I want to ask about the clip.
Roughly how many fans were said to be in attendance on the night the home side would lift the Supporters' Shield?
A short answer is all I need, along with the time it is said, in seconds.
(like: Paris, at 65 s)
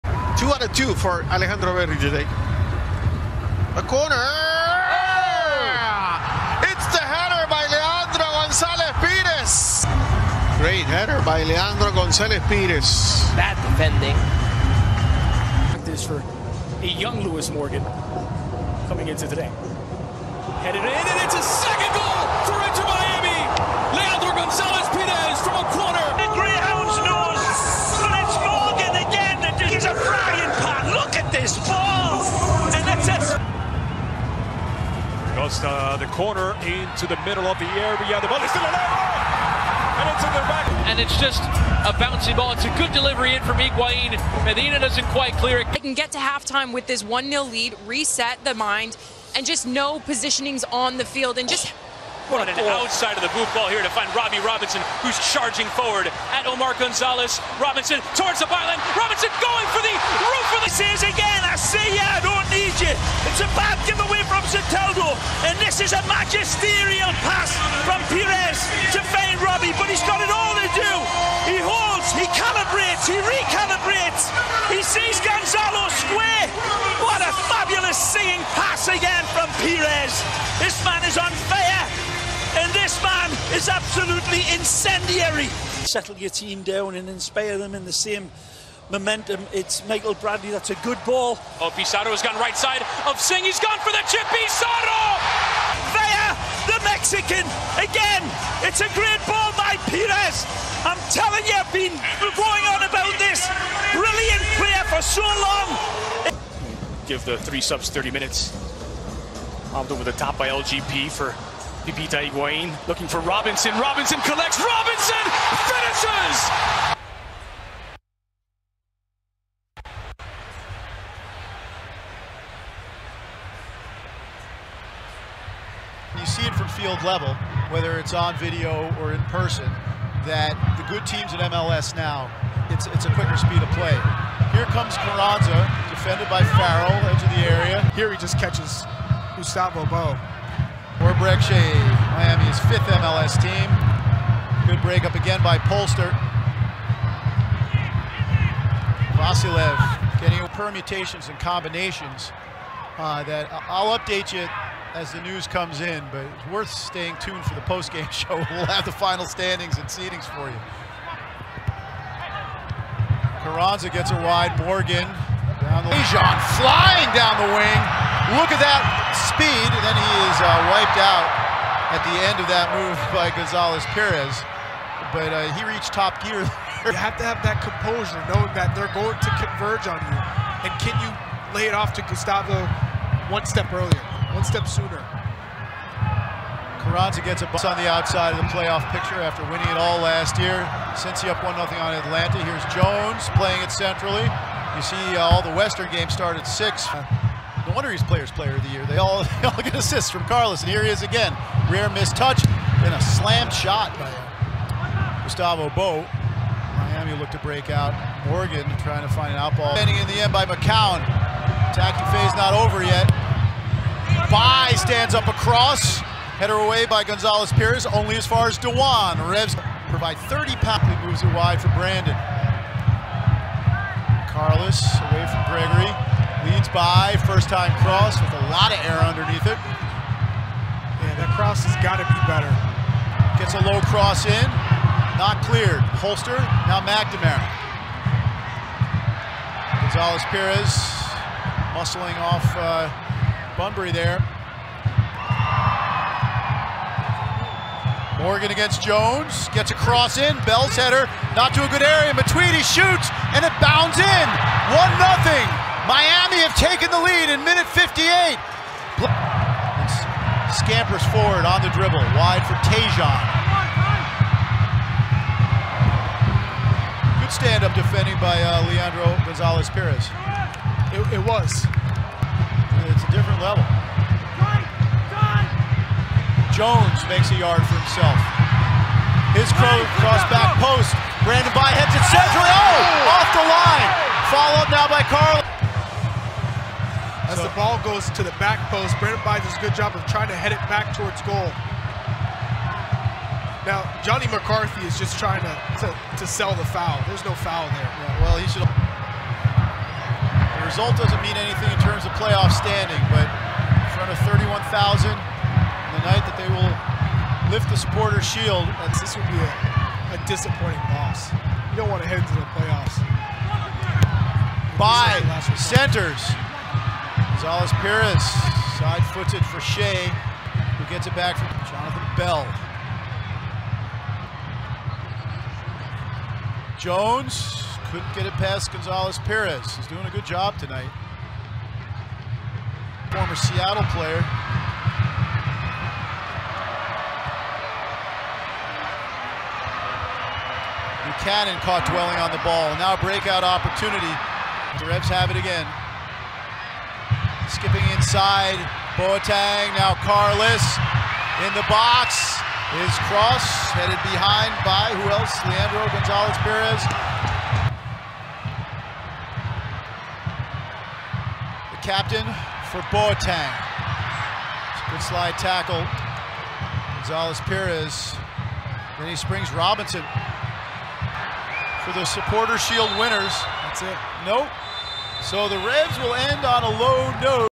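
31,000, at 304 s.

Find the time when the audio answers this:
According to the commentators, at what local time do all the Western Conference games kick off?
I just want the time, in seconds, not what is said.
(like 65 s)
196 s.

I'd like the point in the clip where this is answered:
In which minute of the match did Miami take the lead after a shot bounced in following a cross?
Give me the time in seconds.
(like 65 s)
257 s.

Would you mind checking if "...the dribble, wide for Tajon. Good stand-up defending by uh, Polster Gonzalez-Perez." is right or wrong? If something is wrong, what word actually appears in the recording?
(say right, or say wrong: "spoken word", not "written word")
wrong: "Leandro", not "Polster".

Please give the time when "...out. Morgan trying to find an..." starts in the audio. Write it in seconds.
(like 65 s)
207 s.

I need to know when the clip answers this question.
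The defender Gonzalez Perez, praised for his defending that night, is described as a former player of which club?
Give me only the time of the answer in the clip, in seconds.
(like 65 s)
333 s.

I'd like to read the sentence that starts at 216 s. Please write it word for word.
Header away by Gonzalez Perez, only as far as Dewan.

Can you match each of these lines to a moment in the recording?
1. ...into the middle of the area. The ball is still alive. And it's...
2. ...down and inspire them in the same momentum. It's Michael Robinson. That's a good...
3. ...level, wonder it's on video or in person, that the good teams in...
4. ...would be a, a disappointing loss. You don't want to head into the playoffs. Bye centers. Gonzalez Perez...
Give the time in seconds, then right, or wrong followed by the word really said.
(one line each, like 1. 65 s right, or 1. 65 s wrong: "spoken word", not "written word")
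1. 36 s right
2. 86 s wrong: "Bradley", not "Robinson"
3. 127 s wrong: "whether", not "wonder"
4. 309 s right.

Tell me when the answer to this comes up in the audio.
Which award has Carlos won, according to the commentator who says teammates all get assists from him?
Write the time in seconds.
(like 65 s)
198 s.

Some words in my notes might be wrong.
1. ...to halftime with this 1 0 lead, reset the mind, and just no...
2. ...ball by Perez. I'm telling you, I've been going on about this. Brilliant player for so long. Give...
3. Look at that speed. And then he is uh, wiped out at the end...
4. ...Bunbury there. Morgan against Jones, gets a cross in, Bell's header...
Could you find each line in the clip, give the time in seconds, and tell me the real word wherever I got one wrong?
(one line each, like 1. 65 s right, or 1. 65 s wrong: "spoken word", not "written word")
1. 46 s right
2. 99 s right
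3. 168 s right
4. 243 s right.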